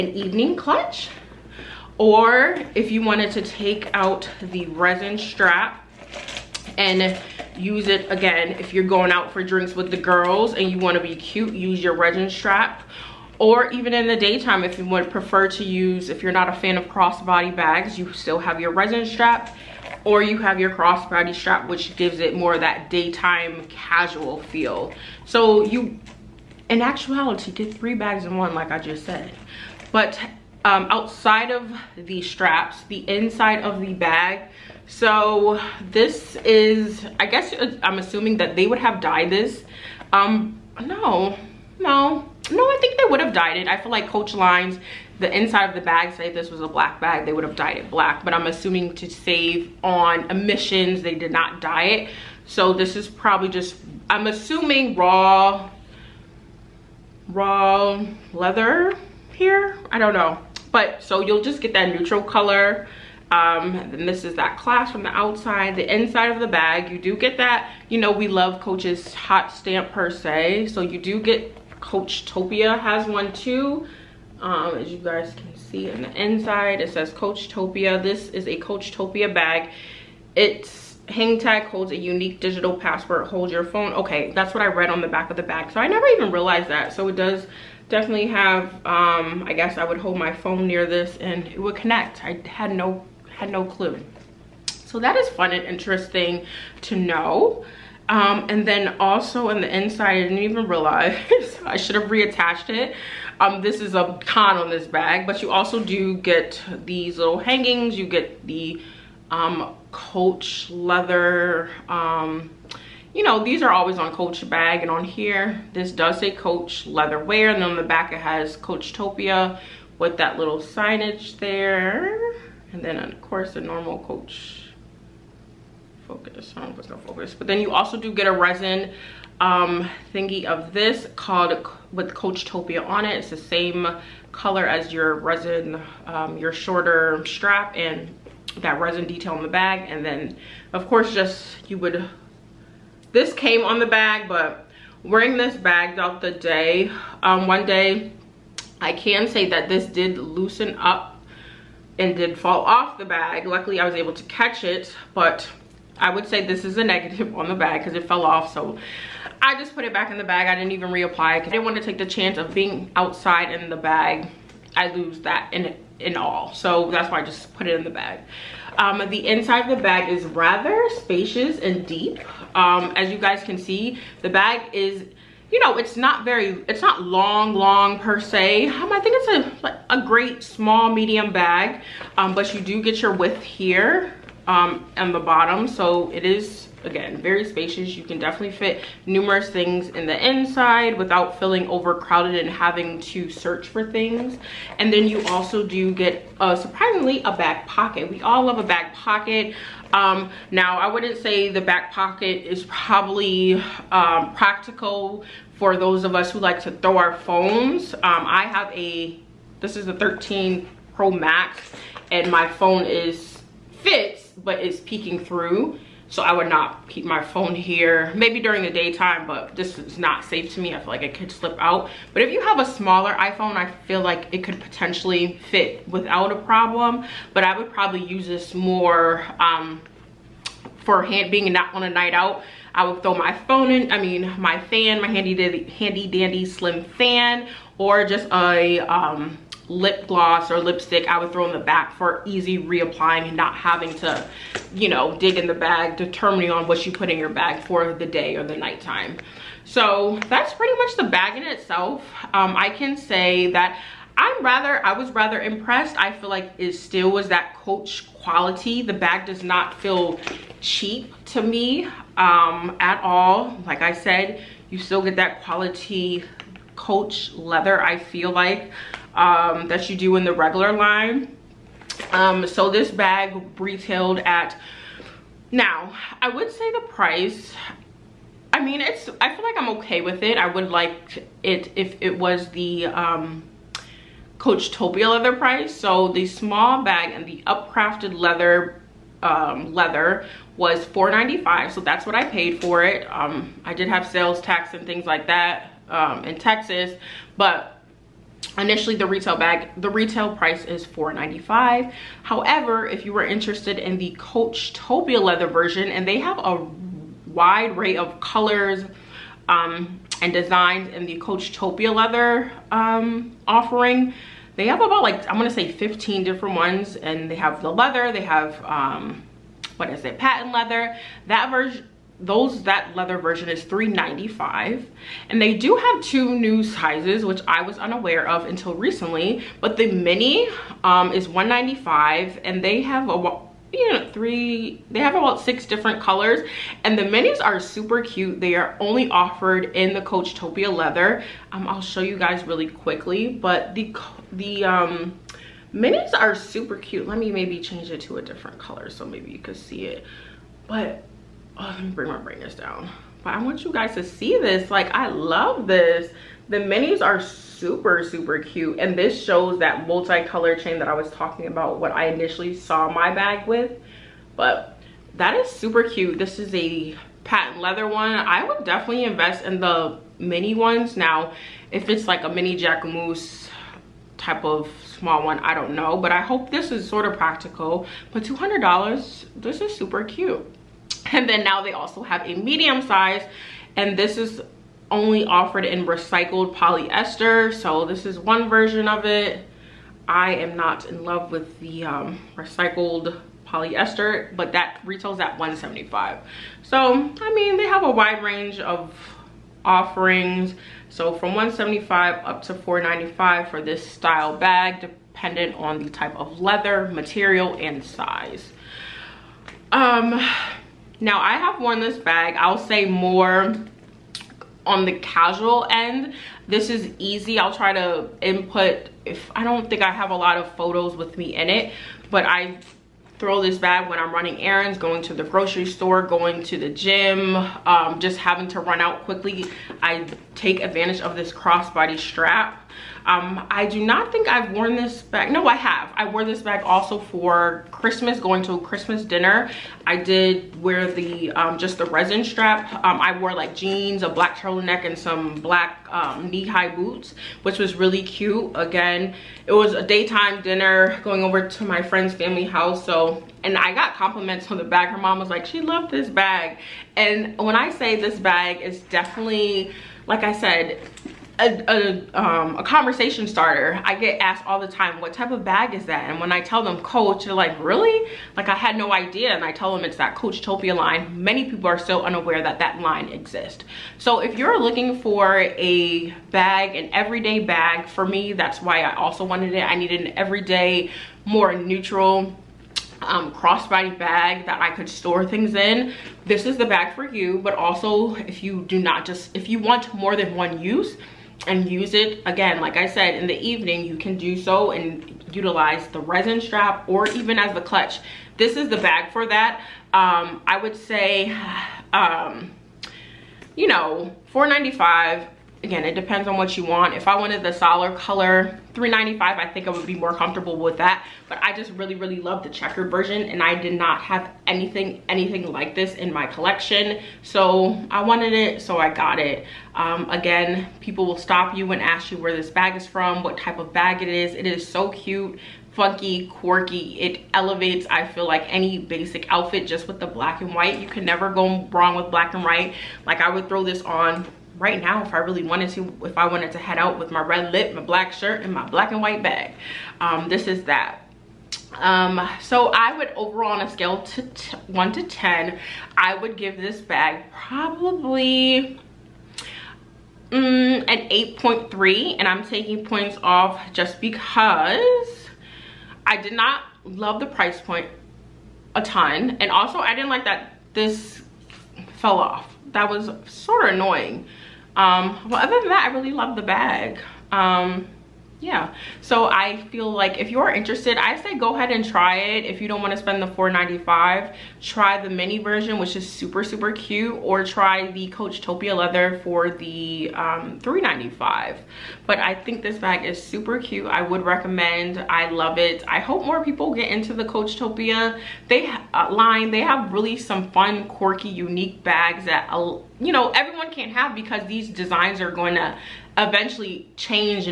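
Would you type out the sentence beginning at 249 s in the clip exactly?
So that's pretty much the bag in itself.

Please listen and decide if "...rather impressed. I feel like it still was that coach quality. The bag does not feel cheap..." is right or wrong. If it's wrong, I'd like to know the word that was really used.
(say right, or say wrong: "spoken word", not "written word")
right.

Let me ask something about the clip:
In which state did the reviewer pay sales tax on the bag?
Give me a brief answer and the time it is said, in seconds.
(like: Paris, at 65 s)
Texas, at 296 s.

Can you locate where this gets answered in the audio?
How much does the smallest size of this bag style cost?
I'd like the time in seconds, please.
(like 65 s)
331 s.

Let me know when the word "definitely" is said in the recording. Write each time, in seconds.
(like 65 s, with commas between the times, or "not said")
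87 s, 188 s, 368 s, 458 s.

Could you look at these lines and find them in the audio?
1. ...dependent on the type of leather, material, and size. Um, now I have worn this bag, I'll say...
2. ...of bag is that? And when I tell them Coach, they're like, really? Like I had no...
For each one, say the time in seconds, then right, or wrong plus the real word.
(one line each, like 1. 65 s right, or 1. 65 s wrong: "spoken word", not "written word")
1. 404 s right
2. 465 s right.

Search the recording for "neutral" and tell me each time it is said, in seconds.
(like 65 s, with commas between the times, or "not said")
61 s, 481 s.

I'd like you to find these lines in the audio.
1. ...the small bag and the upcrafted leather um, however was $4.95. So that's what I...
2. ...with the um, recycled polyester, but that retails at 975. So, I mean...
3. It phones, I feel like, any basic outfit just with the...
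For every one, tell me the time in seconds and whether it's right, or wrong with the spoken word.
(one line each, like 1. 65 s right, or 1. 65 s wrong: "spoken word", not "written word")
1. 286 s wrong: "leather", not "however"
2. 391 s wrong: "175", not "975"
3. 526 s wrong: "elevates", not "phones".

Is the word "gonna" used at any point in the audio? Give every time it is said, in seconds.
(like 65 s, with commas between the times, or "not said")
126 s, 315 s.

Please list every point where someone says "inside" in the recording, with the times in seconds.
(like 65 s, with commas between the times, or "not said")
33 s, 45 s, 65 s, 76 s, 99 s, 169 s, 190 s.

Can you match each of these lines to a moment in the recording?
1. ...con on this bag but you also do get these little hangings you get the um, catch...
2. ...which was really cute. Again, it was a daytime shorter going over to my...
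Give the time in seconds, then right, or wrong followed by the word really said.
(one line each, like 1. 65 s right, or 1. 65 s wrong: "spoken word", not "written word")
1. 104 s wrong: "coach", not "catch"
2. 447 s wrong: "dinner", not "shorter".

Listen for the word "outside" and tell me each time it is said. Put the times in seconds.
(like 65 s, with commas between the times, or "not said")
30 s, 65 s, 162 s.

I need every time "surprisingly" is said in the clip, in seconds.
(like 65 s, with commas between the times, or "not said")
196 s.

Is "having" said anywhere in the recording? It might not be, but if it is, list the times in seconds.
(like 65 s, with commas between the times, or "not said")
192 s, 243 s, 428 s.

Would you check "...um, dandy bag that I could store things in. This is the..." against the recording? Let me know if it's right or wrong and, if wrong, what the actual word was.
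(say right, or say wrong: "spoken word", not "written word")
wrong: "crossbody", not "dandy".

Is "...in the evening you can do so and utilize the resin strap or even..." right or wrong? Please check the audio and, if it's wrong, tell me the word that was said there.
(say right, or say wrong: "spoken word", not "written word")
right.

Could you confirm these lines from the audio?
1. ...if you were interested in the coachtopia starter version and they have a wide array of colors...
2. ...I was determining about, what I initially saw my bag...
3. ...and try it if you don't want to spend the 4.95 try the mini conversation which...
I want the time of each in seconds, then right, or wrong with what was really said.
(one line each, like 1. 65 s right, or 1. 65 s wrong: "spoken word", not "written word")
1. 302 s wrong: "leather", not "starter"
2. 360 s wrong: "talking", not "determining"
3. 571 s wrong: "version", not "conversation".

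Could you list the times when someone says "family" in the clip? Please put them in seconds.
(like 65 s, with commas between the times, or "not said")
452 s.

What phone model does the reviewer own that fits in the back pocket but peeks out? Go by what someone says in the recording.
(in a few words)
13 Pro Max.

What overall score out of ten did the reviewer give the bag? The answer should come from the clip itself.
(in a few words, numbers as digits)
8.3.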